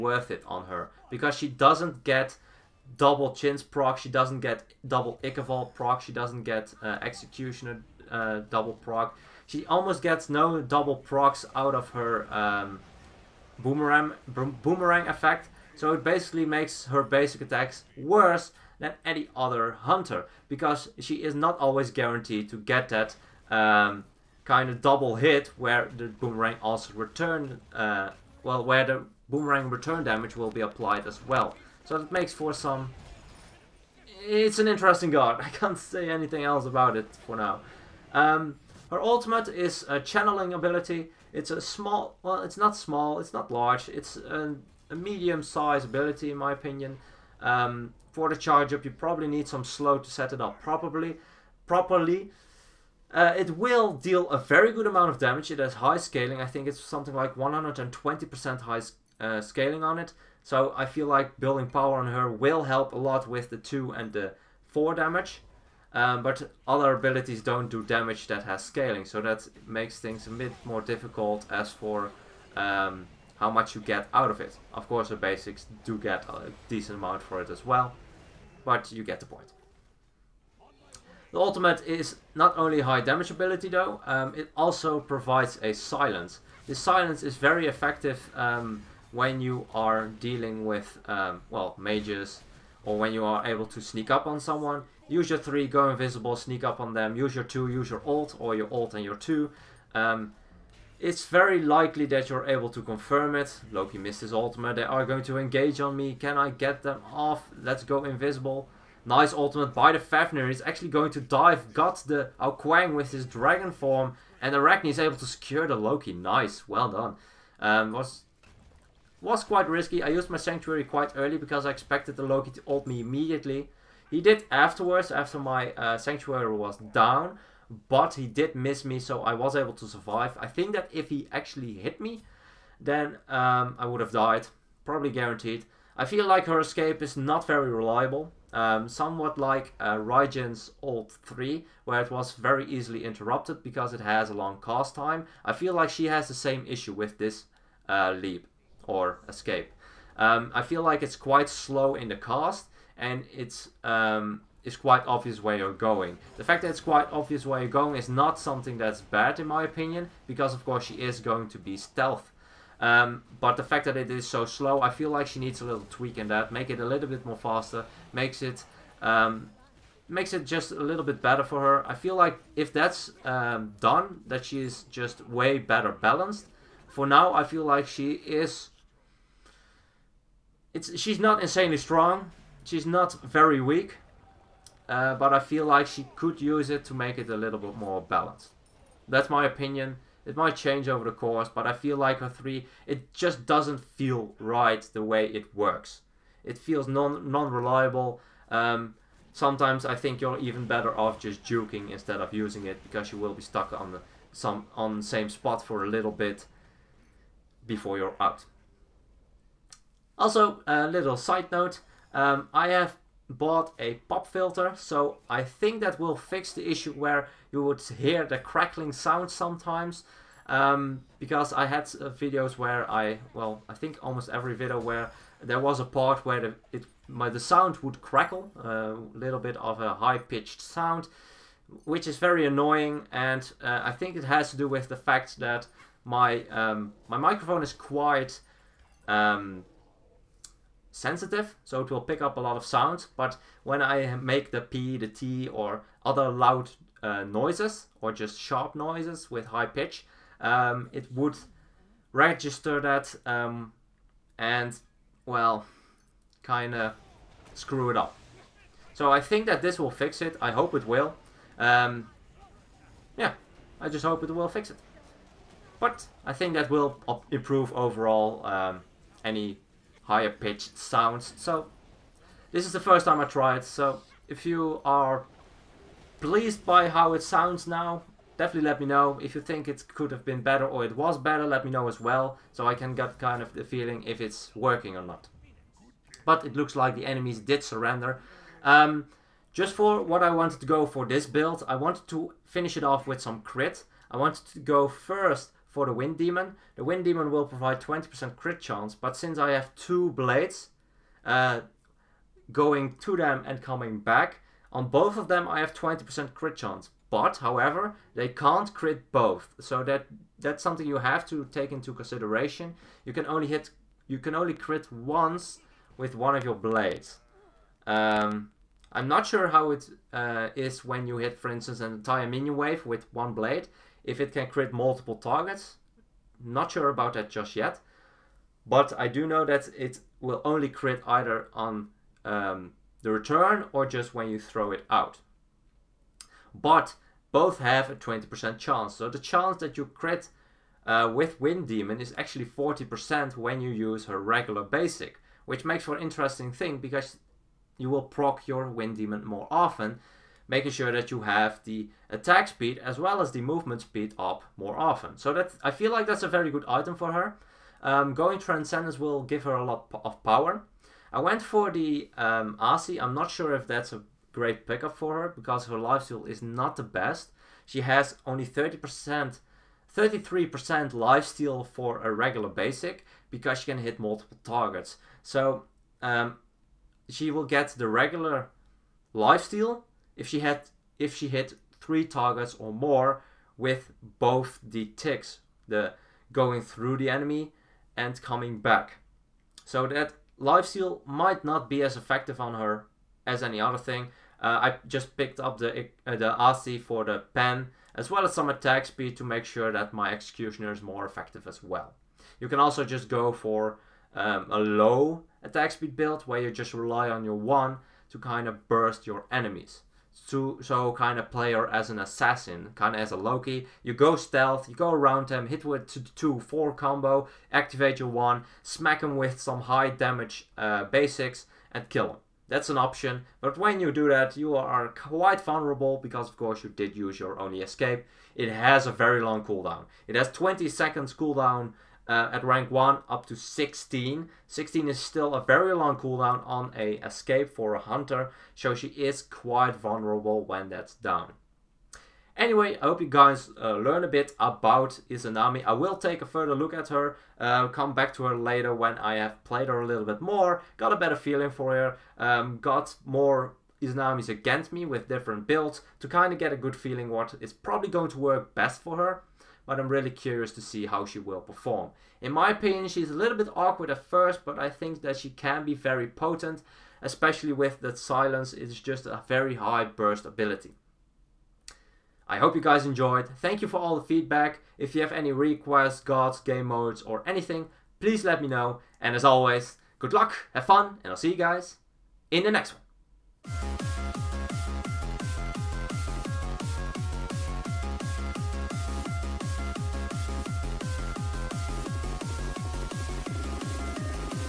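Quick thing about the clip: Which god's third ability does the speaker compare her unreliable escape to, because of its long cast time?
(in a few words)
Raijin.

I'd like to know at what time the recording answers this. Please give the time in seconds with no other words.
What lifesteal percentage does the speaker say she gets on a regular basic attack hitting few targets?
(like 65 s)
369 s.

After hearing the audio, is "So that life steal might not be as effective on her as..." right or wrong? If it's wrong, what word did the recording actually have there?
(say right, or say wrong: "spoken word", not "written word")
right.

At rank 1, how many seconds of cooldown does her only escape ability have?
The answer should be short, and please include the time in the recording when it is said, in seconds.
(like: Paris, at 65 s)
20 seconds, at 430 s.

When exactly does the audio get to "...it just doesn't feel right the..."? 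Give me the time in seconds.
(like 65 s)
192 s.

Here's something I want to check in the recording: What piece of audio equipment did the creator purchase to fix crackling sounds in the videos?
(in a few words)
A pop filter.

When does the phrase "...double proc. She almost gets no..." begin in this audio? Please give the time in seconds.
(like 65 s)
8 s.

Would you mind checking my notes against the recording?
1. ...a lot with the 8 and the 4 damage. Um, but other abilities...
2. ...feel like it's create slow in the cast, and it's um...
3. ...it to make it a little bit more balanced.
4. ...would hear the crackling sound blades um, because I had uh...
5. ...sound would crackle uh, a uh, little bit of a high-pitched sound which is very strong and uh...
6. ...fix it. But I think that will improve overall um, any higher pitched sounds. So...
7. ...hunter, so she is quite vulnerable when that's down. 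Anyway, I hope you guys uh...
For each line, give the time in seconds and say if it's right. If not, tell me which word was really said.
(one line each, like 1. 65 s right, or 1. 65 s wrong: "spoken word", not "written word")
1. 62 s wrong: "2", not "8"
2. 150 s wrong: "quite", not "create"
3. 186 s right
4. 217 s wrong: "sometimes", not "blades"
5. 227 s wrong: "annoying", not "strong"
6. 264 s right
7. 437 s right.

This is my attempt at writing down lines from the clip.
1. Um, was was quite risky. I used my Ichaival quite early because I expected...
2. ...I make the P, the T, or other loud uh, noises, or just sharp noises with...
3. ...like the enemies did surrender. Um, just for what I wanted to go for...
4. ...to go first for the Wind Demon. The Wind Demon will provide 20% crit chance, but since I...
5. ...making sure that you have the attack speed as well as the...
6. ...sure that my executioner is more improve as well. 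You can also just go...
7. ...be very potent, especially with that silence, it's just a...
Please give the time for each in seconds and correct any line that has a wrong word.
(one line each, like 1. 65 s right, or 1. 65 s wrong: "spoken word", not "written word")
1. 117 s wrong: "Sanctuary", not "Ichaival"
2. 243 s right
3. 286 s right
4. 294 s right
5. 350 s right
6. 399 s wrong: "effective", not "improve"
7. 465 s right.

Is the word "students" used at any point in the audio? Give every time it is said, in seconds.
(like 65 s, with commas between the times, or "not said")
not said.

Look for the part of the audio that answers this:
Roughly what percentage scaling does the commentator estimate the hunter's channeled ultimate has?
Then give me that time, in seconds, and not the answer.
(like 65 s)
57 s.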